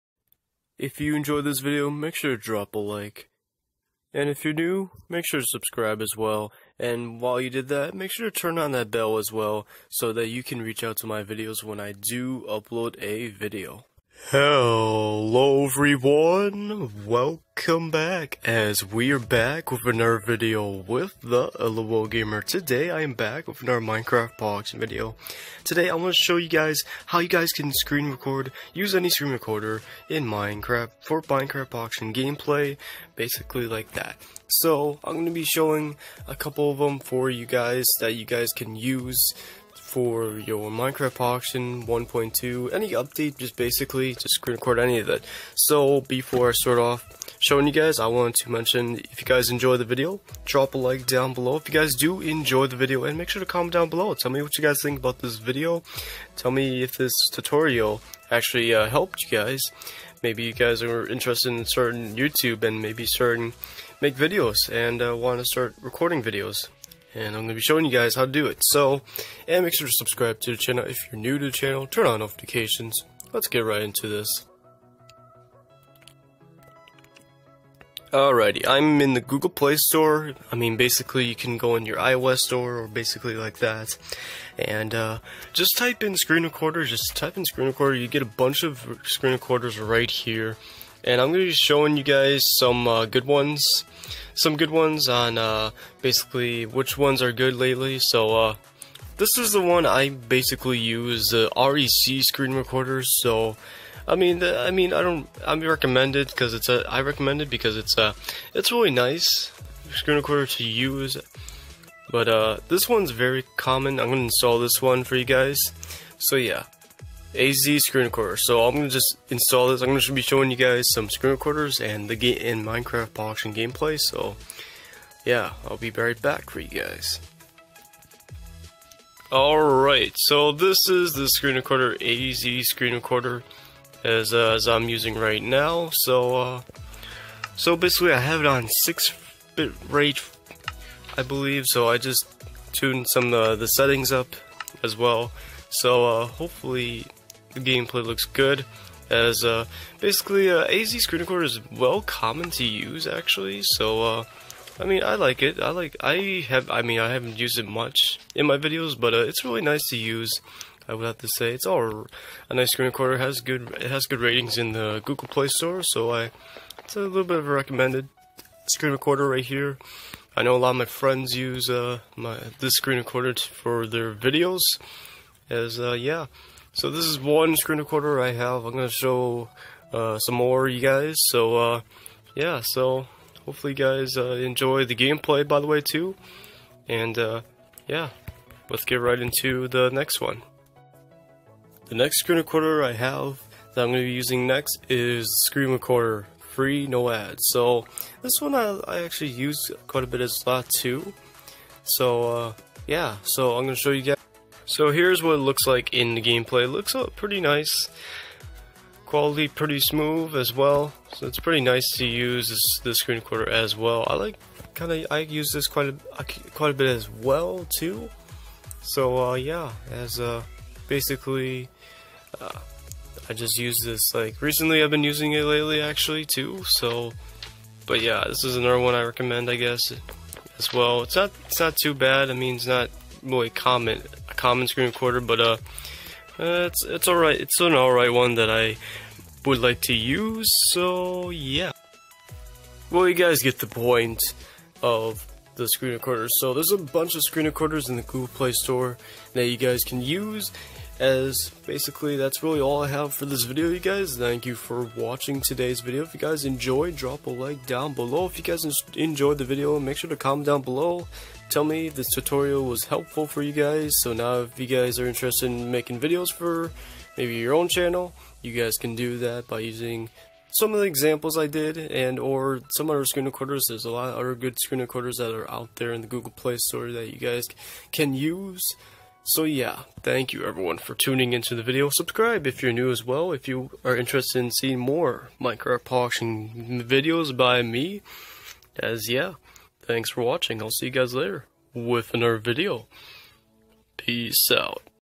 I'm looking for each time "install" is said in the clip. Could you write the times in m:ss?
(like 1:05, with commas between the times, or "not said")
1:54, 1:59.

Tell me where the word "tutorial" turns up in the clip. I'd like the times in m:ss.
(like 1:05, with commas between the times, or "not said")
0:57, 4:22.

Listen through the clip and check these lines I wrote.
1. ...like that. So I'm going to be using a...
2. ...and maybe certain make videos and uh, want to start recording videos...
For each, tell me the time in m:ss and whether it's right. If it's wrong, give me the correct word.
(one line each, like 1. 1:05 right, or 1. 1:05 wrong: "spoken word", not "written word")
1. 0:33 wrong: "showing", not "using"
2. 1:02 right.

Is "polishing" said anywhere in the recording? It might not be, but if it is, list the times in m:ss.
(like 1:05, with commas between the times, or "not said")
2:03, 4:45.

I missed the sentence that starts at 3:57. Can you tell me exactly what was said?
It's an all right one that I would like to use.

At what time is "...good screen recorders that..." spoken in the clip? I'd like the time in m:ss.
4:34.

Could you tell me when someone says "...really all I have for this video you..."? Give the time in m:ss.
4:12.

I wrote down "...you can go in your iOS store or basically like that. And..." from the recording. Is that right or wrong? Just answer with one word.
right.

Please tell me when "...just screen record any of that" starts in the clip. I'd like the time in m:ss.
0:44.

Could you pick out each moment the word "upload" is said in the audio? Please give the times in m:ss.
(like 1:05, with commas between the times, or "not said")
0:12.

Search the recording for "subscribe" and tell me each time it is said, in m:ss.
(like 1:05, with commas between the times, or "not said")
0:05, 1:09, 4:41.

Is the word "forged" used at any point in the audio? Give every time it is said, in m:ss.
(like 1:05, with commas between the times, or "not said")
not said.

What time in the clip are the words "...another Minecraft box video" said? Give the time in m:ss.
0:23.